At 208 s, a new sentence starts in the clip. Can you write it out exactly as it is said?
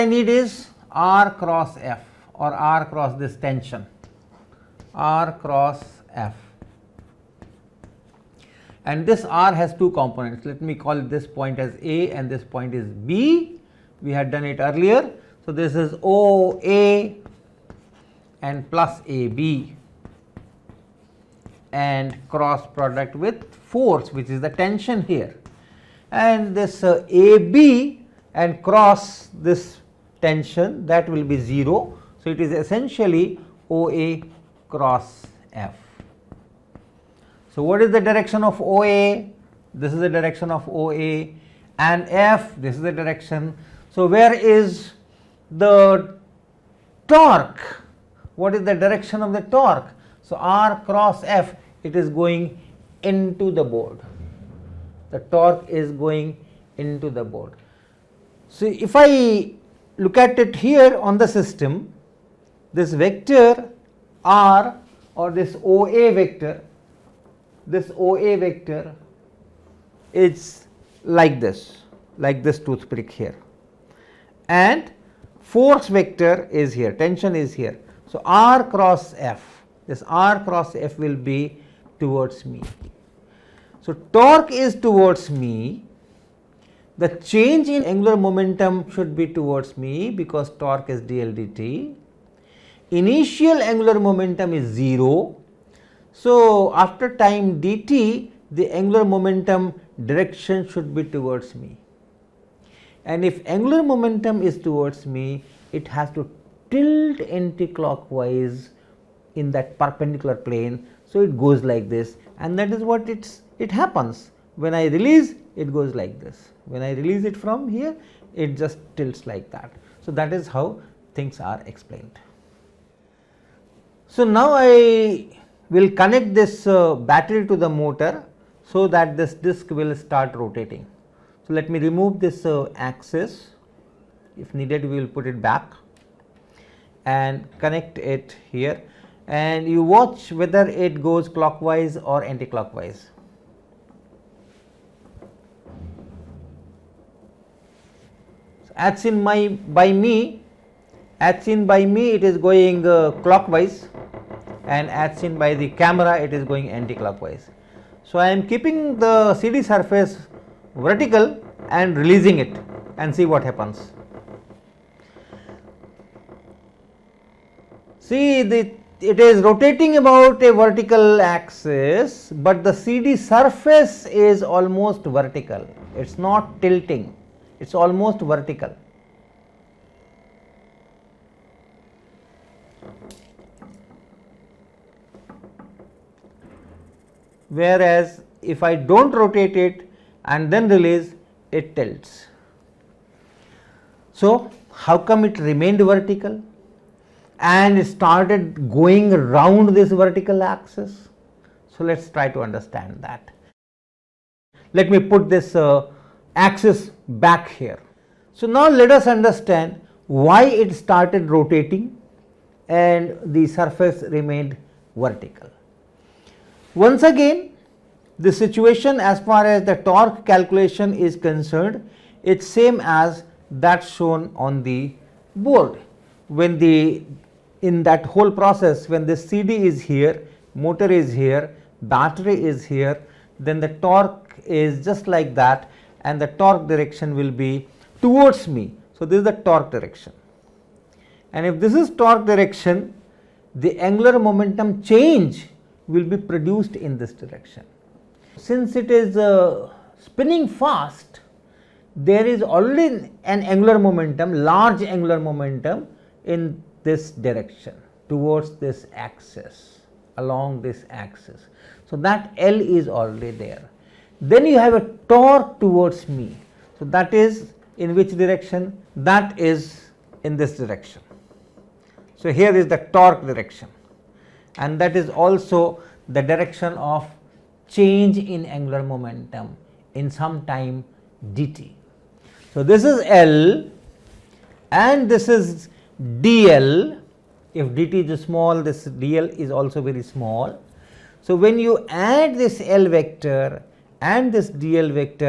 So now let us understand why it started rotating and the surface remained vertical.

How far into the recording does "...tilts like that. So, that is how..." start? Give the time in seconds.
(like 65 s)
118 s.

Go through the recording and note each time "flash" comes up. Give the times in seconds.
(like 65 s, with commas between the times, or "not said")
not said.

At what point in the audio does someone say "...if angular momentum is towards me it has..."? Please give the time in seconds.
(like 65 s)
103 s.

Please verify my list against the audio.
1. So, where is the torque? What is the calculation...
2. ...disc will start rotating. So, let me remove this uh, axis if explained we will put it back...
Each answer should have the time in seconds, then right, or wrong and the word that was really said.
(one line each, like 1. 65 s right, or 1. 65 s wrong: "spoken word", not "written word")
1. 43 s wrong: "direction", not "calculation"
2. 129 s wrong: "needed", not "explained".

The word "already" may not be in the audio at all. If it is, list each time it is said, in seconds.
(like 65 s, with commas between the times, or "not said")
252 s, 262 s.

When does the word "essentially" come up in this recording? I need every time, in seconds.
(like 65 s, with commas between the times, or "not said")
32 s.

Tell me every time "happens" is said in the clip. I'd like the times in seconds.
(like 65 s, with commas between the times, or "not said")
113 s, 163 s.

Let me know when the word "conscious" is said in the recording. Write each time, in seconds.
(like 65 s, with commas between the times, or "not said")
not said.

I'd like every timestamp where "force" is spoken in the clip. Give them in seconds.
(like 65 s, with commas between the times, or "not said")
23 s, 75 s.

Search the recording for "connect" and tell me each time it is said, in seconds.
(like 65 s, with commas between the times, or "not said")
125 s, 137 s.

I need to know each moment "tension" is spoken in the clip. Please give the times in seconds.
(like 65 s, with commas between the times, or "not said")
3 s, 24 s, 30 s, 76 s.